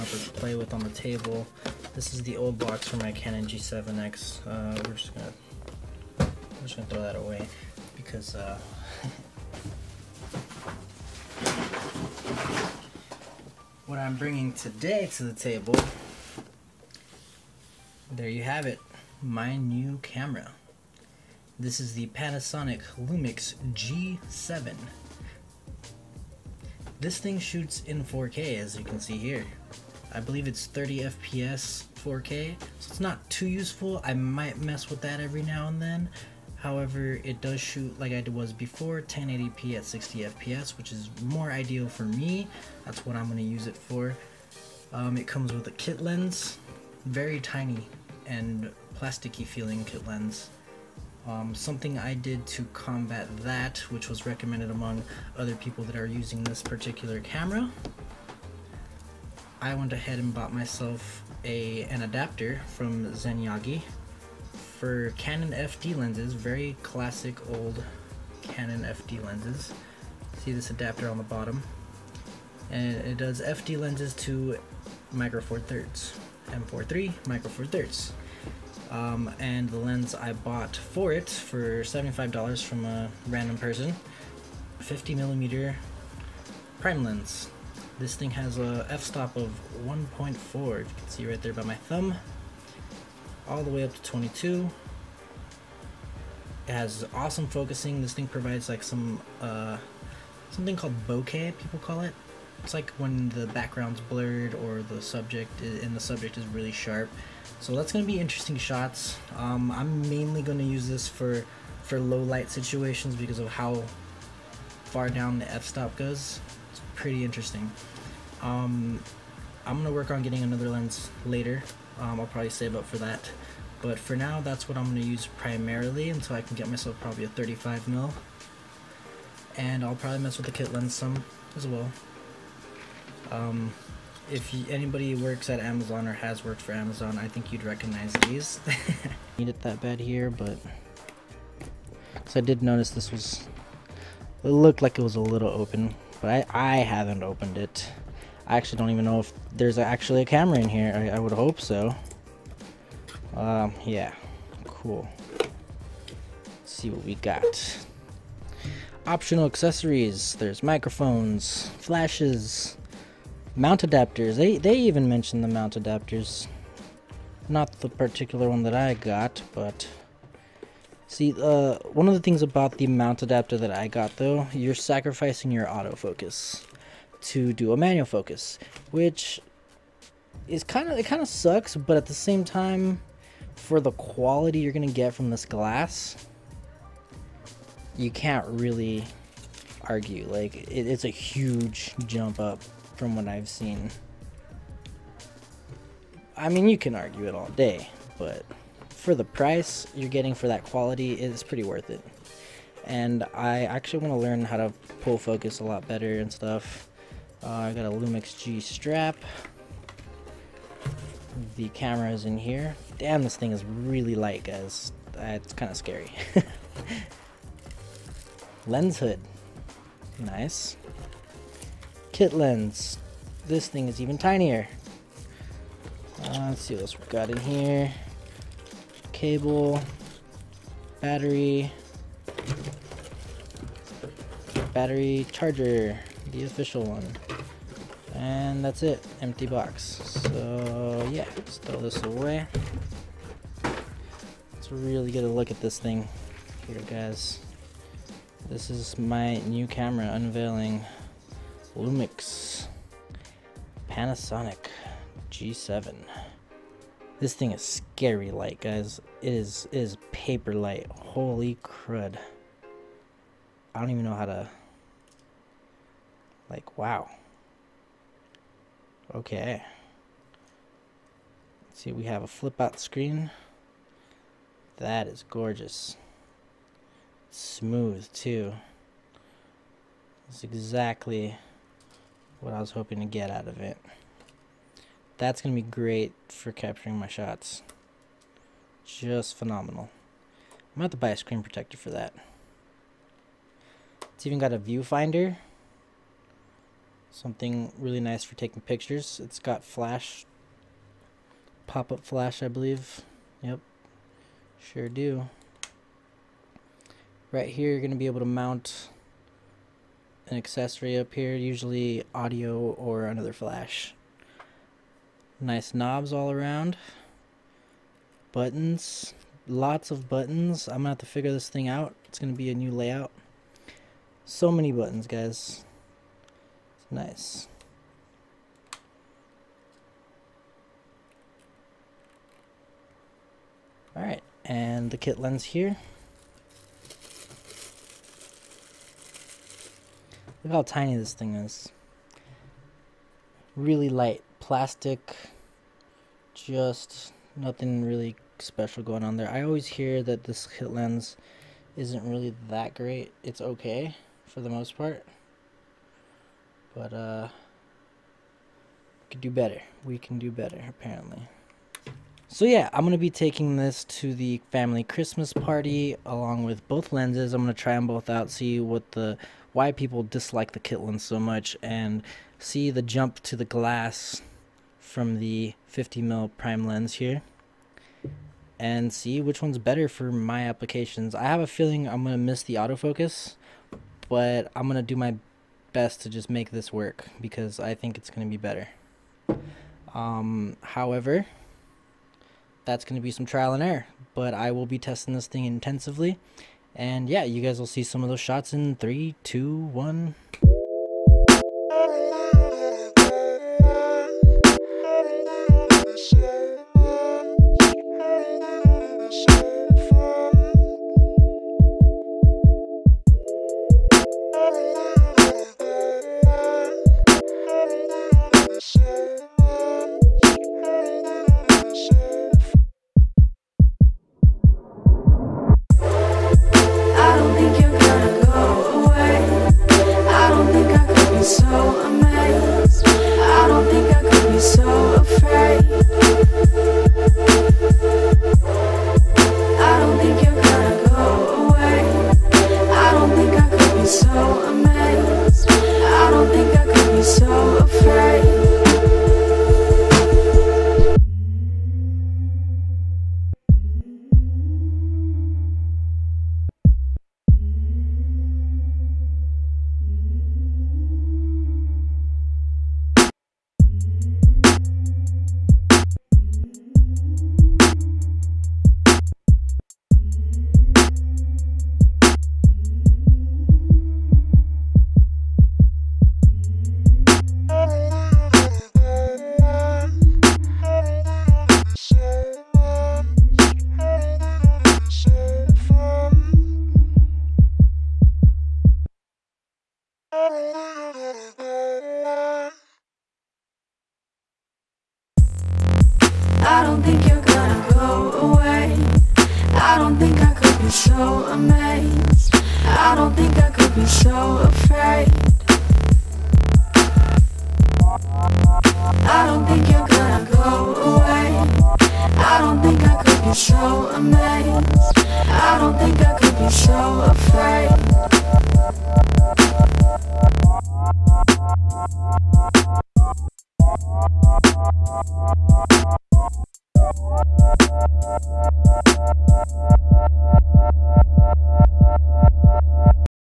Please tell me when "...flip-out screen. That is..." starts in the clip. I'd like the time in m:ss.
4:32.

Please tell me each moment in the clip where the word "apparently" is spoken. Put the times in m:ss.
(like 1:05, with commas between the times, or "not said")
6:00.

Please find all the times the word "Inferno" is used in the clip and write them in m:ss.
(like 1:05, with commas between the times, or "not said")
not said.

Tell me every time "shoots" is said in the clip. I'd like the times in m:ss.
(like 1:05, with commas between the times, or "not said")
0:27, 0:37.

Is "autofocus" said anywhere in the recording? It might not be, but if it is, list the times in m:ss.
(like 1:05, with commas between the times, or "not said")
2:55, 6:22.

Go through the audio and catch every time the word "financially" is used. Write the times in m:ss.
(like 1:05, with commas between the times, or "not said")
not said.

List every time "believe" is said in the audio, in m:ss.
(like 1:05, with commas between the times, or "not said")
0:30, 5:02.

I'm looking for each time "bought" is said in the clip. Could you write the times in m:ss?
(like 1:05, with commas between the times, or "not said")
1:00, 1:20.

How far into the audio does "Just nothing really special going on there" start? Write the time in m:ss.
5:46.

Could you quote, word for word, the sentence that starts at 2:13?
Um, if you, anybody works at Amazon or has worked for Amazon, I think you'd recognize these.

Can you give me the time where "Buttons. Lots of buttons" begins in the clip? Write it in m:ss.
5:18.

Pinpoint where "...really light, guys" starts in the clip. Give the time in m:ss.
3:33.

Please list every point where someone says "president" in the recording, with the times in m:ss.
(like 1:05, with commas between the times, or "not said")
not said.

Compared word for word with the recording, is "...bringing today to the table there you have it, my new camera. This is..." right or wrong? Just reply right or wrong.
right.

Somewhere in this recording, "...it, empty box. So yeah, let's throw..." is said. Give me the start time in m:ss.
3:58.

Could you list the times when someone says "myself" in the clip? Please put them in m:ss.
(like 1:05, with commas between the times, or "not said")
1:00, 2:06.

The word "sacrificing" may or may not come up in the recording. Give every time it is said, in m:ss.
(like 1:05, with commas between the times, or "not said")
2:54.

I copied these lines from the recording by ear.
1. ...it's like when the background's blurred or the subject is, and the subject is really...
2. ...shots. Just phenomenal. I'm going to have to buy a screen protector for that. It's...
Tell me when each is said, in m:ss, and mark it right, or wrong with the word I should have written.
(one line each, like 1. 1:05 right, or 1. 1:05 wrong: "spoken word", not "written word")
1. 1:42 right
2. 4:47 right.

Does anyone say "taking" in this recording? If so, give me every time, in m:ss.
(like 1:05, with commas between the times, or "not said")
4:58, 6:03.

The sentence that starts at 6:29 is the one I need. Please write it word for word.
Um, however, that's going to be some trial and error.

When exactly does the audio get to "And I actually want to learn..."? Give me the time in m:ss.
3:22.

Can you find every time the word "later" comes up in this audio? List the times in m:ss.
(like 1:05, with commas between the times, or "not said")
2:01.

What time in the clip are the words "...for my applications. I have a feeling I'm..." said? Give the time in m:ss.
6:19.